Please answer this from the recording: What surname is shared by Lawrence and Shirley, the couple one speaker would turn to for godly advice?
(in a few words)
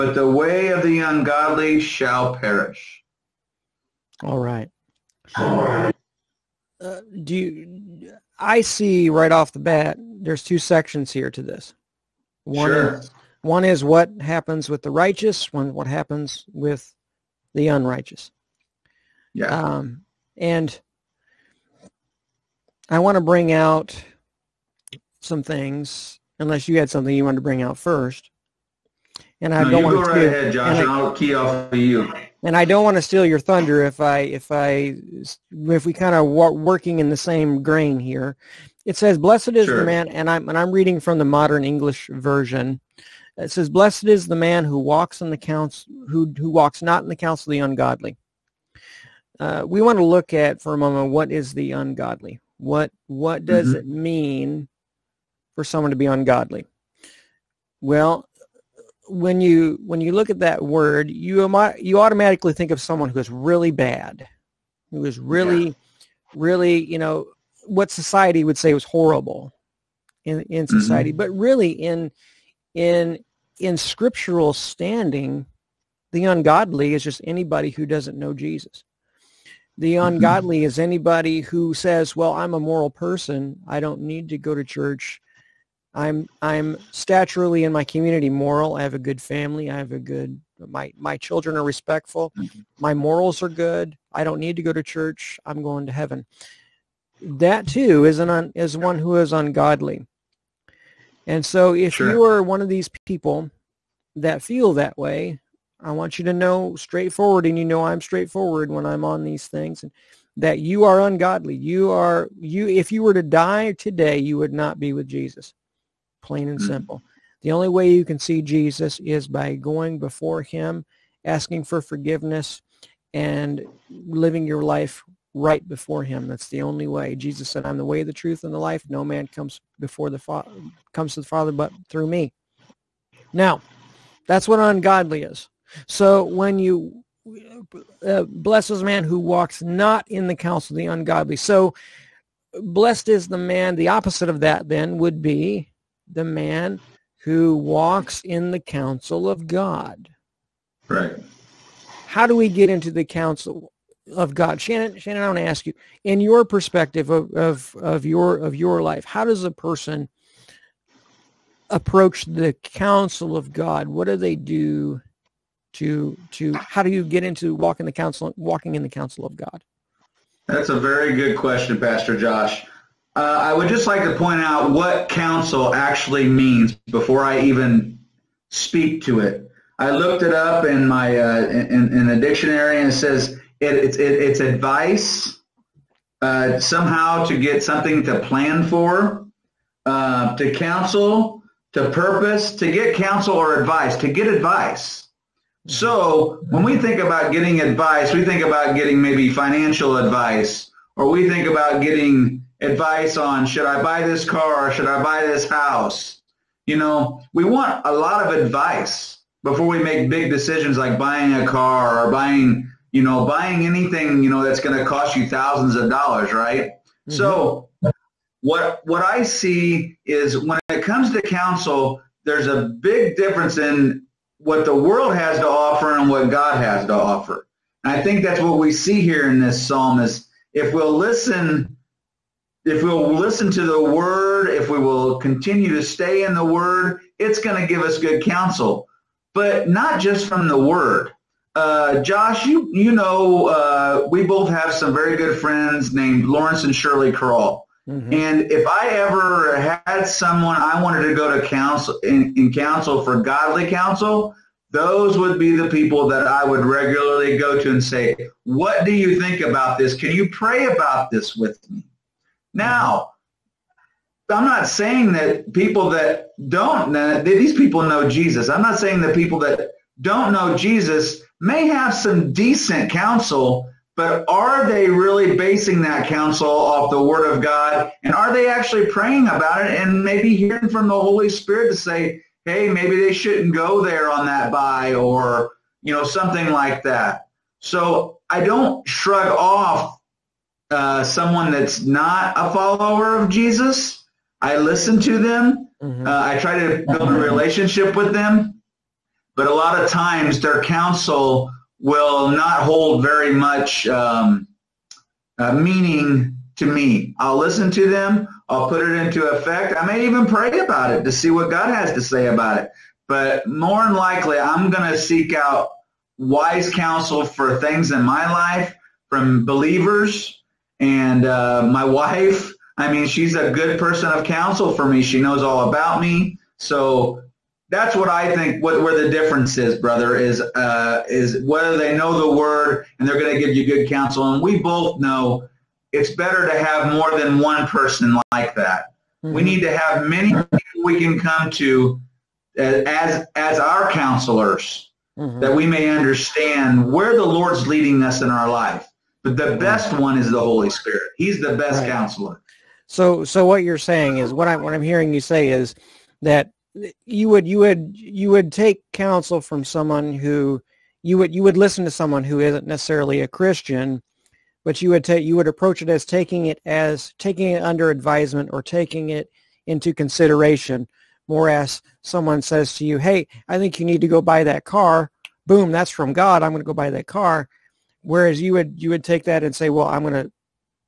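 Crawl.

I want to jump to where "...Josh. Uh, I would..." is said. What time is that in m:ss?
2:52.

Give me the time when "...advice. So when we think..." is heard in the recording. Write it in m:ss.
3:14.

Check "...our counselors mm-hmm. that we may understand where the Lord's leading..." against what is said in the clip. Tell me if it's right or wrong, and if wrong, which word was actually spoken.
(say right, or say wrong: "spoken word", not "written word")
right.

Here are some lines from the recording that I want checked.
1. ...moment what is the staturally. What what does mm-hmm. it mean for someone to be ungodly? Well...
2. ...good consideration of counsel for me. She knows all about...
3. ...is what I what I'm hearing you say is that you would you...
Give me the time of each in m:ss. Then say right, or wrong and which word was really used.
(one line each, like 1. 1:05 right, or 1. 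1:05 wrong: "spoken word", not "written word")
1. 0:50 wrong: "ungodly", not "staturally"
2. 5:23 wrong: "person", not "consideration"
3. 5:54 right.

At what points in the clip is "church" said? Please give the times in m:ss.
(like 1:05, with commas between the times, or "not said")
1:24, 1:34.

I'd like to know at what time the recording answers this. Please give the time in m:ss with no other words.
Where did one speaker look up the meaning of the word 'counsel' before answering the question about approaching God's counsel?
3:02.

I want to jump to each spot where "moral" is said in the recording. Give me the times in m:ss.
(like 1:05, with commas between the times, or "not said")
1:22, 1:28, 1:32.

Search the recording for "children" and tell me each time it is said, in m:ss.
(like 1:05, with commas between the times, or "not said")
1:31.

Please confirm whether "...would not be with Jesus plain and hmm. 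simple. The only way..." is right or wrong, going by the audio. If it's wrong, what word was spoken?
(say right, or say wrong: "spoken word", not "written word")
right.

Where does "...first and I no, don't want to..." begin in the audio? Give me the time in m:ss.
0:27.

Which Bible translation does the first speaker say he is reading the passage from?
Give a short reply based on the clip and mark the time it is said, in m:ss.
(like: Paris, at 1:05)
Modern English Version, at 0:41.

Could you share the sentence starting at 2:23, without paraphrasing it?
The opposite of that then would be the man who walks in the counsel of God.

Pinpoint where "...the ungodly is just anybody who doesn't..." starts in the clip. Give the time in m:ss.
1:16.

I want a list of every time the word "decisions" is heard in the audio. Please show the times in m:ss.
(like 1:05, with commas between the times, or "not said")
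3:30.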